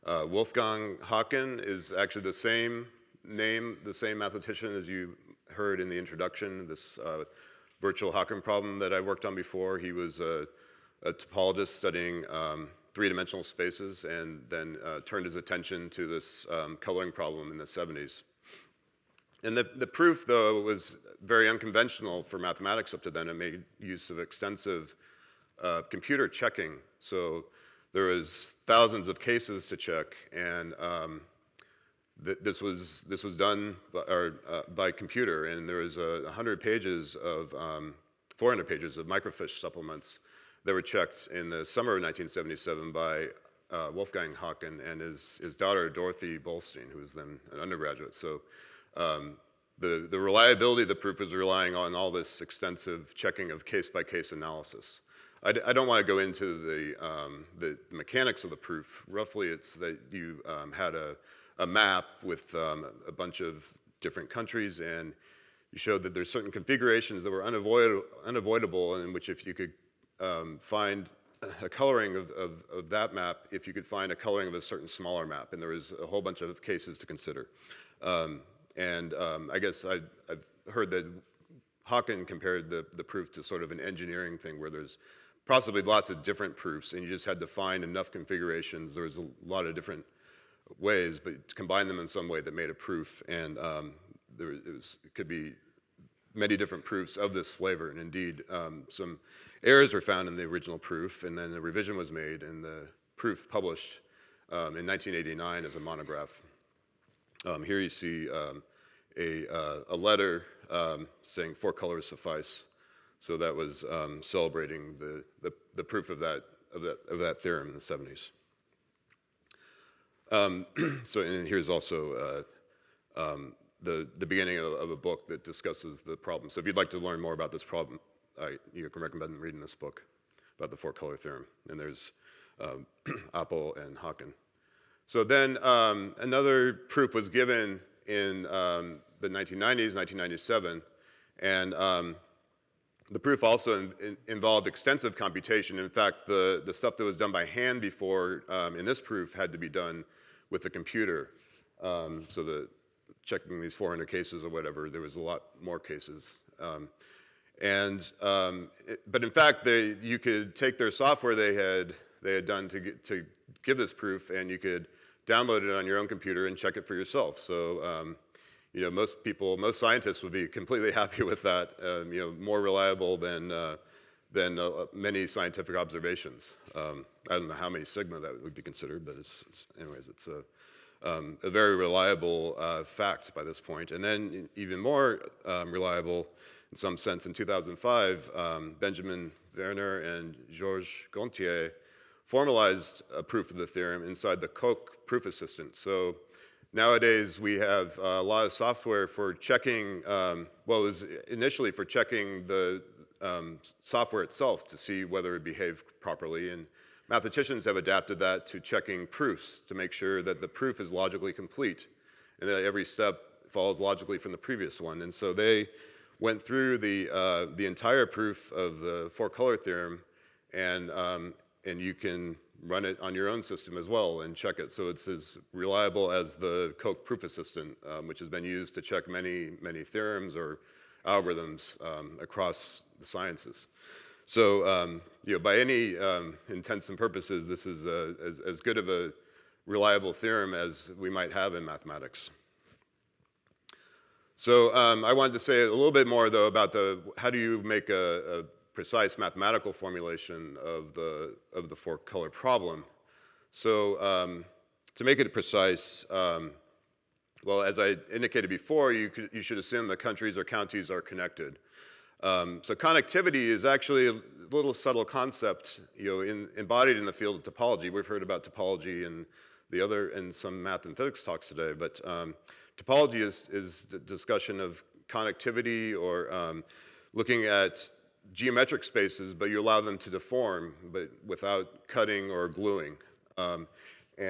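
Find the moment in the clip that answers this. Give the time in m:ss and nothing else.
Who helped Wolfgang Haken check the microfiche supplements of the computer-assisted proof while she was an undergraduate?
0:45.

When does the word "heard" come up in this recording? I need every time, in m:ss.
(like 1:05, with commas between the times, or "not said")
0:05, 1:20, 4:28.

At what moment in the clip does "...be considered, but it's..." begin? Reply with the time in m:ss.
2:58.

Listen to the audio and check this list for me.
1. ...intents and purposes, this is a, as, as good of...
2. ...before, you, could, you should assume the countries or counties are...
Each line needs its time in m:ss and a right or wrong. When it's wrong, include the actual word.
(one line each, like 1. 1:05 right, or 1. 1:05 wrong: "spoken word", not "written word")
1. 3:56 right
2. 4:18 right.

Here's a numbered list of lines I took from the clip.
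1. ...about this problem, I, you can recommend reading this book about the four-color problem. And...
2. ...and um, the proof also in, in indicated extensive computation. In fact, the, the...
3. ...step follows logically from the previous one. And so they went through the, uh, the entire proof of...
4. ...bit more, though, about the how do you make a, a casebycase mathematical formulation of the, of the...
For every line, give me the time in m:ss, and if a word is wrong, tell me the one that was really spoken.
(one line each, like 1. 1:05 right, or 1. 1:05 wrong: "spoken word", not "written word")
1. 2:07 wrong: "theorem", not "problem"
2. 2:21 wrong: "involved", not "indicated"
3. 3:32 right
4. 4:05 wrong: "precise", not "casebycase".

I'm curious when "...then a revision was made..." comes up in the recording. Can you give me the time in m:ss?
1:41.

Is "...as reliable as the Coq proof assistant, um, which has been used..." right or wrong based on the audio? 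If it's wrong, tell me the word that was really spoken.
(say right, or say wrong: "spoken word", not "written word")
right.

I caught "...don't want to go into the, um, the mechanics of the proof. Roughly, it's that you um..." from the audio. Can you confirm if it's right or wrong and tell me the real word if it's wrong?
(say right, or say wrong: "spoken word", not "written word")
right.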